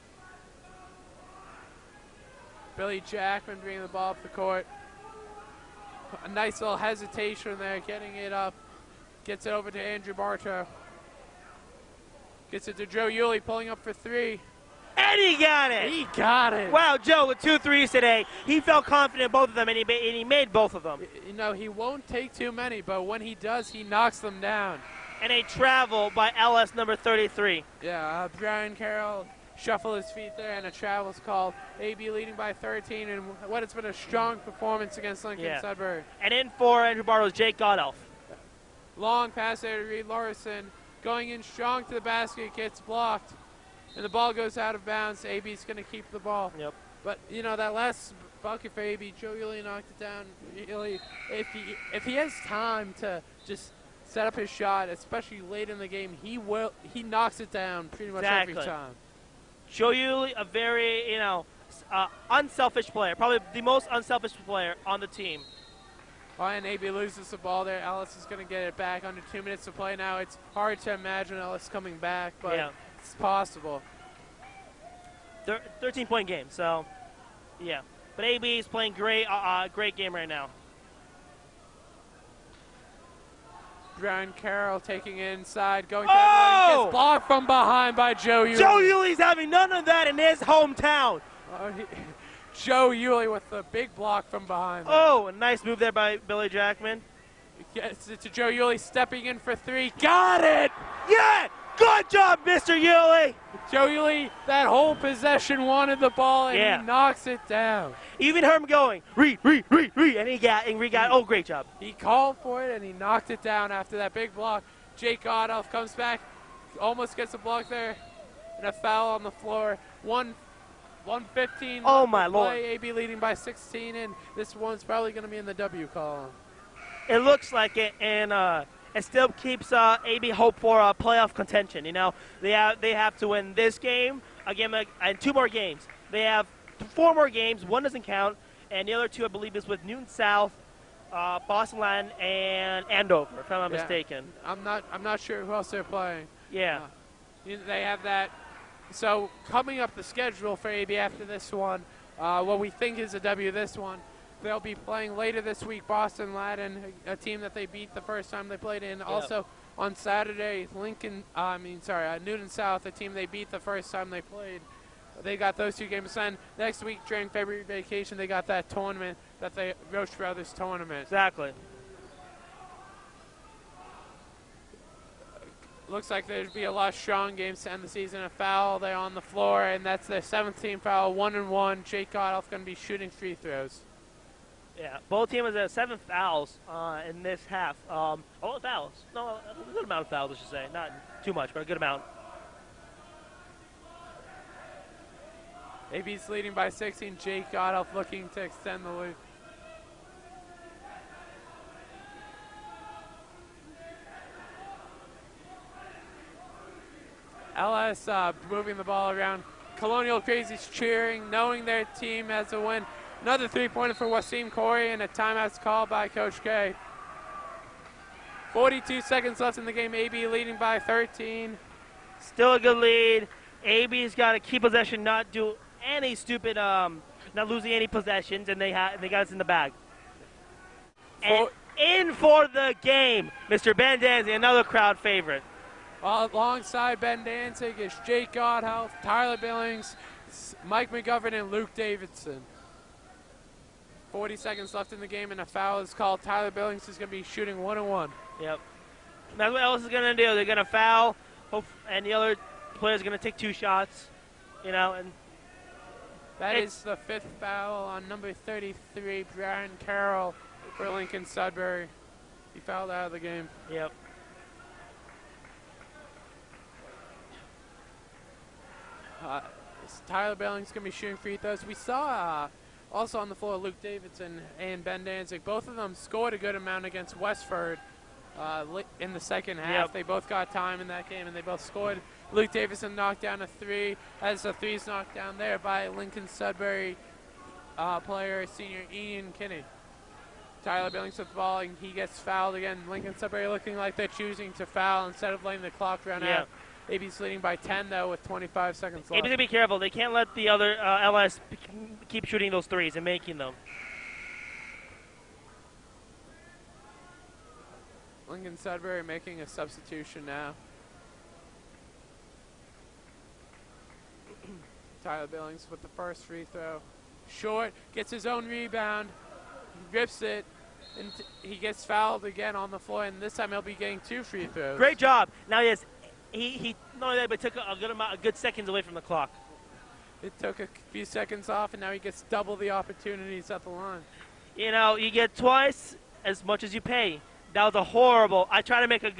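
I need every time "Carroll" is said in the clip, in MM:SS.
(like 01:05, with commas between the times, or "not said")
00:28, 01:24, 04:19.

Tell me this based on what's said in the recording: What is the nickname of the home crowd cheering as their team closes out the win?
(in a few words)
Colonial Crazies.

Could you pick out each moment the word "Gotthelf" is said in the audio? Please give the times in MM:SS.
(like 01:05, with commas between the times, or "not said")
00:37, 01:55, 03:02, 03:17, 03:58.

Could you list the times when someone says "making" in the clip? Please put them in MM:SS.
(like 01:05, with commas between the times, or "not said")
05:03, 05:09.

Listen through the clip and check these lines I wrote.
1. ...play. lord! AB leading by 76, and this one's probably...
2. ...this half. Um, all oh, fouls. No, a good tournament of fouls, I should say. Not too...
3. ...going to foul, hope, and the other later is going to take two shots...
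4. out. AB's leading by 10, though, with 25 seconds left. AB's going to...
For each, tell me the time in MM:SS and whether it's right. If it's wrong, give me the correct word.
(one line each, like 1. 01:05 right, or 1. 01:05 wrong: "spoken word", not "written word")
1. 02:02 wrong: "16", not "76"
2. 03:07 wrong: "amount", not "tournament"
3. 04:10 wrong: "player", not "later"
4. 04:56 right.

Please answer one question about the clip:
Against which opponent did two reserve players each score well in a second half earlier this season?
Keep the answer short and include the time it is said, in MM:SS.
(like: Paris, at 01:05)
Westford, at 04:37.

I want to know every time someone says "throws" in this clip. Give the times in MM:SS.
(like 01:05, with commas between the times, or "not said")
03:03, 04:31, 05:16, 05:24.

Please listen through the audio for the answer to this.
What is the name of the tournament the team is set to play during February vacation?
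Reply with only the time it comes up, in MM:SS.
02:49.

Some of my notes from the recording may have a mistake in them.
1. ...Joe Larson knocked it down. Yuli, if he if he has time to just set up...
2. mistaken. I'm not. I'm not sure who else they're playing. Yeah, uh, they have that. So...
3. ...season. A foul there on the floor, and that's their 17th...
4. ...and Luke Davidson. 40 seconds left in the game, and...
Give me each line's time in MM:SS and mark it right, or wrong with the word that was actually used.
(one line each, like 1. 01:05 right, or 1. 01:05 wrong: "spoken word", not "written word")
1. 00:49 wrong: "Yuli", not "Larson"
2. 02:23 right
3. 02:57 right
4. 04:01 right.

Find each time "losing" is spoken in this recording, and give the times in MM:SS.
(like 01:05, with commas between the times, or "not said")
03:47.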